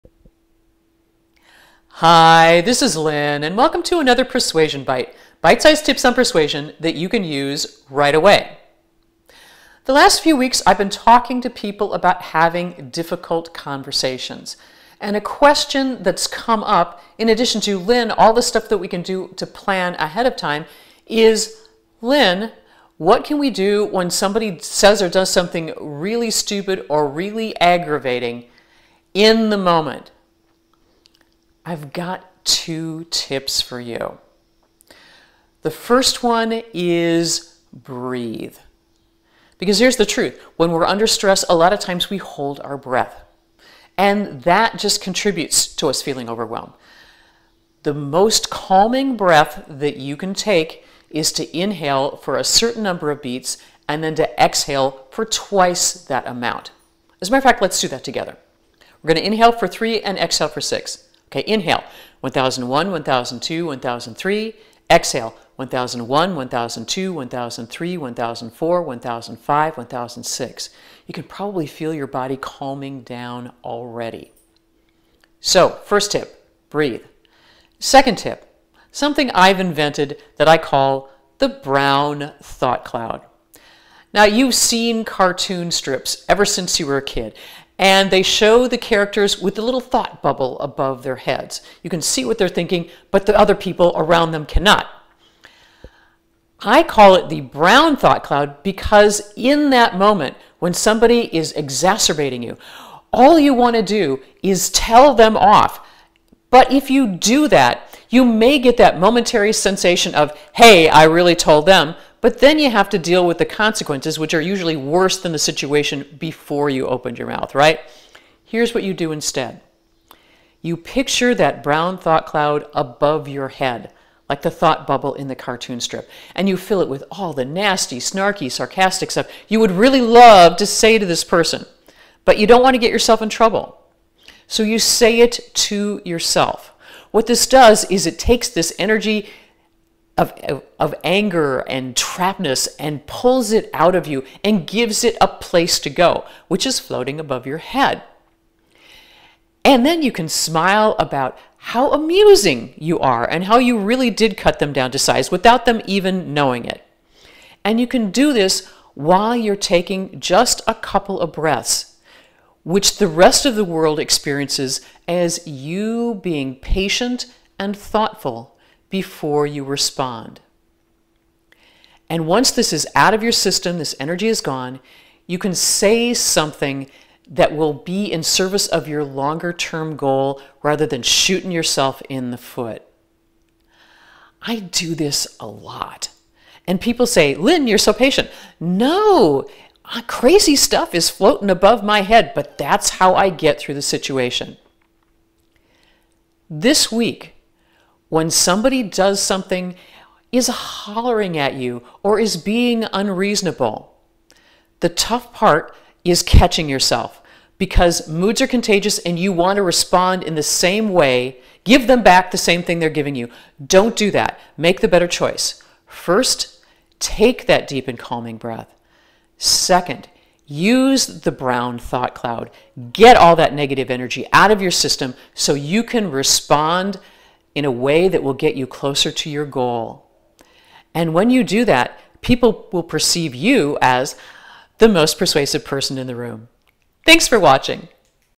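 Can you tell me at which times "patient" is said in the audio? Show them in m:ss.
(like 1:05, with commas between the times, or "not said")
2:46, 3:07.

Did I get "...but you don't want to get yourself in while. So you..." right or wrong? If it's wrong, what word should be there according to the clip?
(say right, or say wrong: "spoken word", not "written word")
wrong: "trouble", not "while".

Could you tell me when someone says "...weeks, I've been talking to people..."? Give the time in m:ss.
0:10.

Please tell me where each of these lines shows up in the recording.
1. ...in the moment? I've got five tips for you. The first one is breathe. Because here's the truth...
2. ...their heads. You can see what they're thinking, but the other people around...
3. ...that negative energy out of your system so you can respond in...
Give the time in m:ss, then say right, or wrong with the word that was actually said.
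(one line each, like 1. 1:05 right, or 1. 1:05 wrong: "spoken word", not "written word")
1. 0:29 wrong: "two", not "five"
2. 1:31 right
3. 3:43 right.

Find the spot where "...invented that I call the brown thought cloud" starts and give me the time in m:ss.
1:19.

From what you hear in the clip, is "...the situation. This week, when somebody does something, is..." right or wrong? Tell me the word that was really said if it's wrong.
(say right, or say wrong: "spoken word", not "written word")
right.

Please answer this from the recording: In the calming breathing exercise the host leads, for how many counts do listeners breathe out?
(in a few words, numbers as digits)
6.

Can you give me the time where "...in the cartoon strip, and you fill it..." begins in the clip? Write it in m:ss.
2:05.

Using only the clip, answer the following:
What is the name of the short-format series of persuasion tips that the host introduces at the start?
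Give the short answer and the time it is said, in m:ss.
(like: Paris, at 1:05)
Persuasion Byte, at 0:04.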